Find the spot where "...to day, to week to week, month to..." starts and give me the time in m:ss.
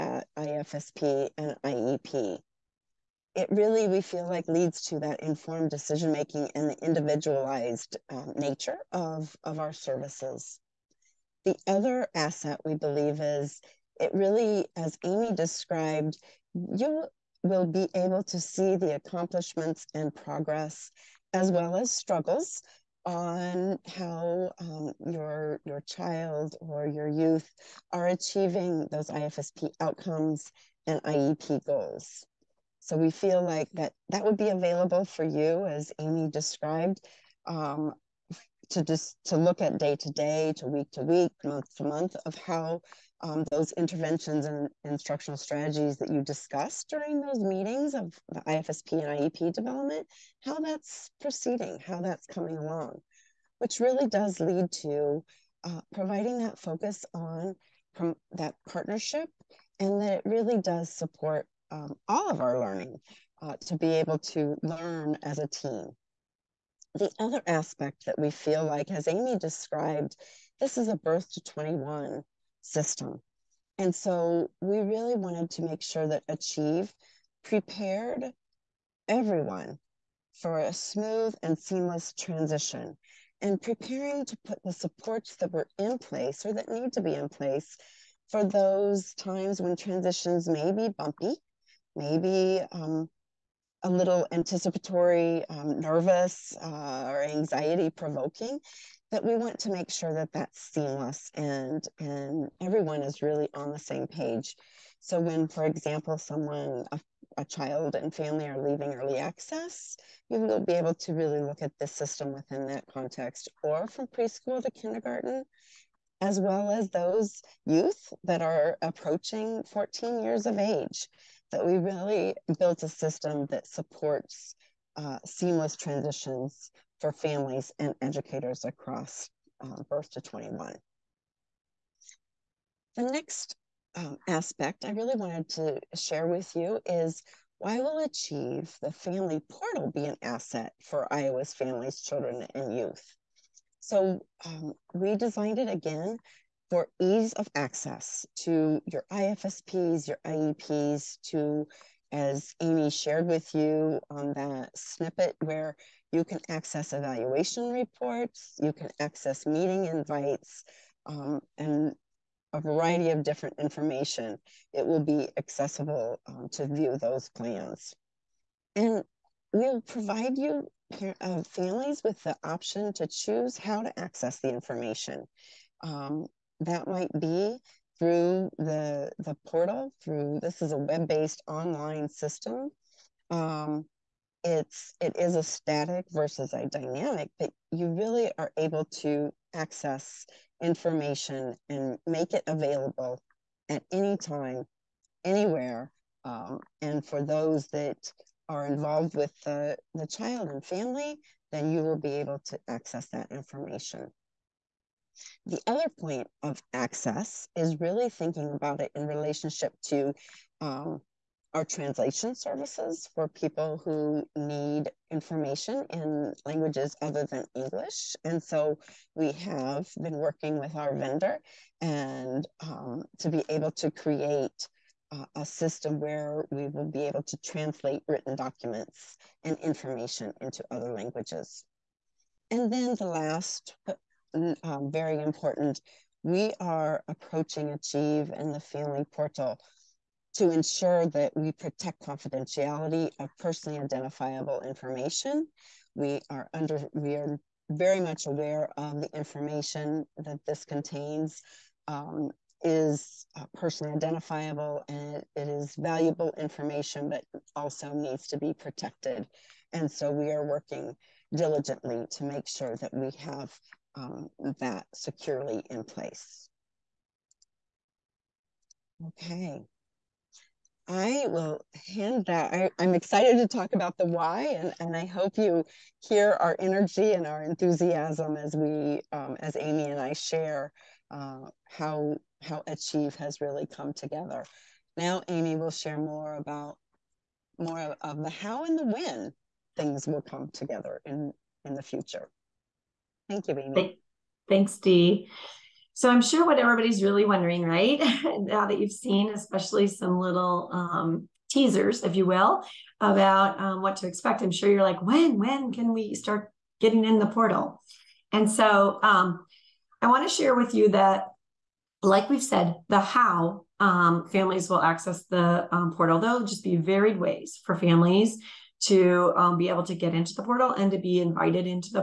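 0:39.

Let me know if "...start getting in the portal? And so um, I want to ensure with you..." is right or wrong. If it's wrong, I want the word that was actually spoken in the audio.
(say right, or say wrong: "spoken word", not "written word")
wrong: "share", not "ensure".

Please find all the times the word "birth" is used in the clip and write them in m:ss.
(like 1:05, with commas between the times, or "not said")
1:10, 2:09.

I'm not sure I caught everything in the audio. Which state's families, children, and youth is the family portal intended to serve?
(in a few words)
Iowa.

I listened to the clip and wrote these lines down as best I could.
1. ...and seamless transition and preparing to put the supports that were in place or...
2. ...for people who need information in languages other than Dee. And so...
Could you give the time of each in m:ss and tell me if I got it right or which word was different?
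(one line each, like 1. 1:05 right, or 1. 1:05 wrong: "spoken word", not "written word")
1. 1:21 right
2. 3:33 wrong: "English", not "Dee".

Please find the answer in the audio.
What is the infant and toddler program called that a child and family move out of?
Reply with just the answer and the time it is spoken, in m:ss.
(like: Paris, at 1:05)
Early Access, at 1:48.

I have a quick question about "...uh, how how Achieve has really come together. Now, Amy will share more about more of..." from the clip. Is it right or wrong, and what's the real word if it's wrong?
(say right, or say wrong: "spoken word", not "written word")
right.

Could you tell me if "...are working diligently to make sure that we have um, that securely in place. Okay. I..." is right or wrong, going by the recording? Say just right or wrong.
right.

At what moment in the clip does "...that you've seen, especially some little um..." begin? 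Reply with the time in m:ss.
4:58.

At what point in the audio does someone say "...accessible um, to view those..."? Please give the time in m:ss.
2:45.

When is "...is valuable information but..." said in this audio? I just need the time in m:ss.
4:15.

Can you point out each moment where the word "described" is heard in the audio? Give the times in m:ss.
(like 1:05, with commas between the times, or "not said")
0:15, 0:36, 1:09.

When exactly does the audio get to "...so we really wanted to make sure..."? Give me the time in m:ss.
1:13.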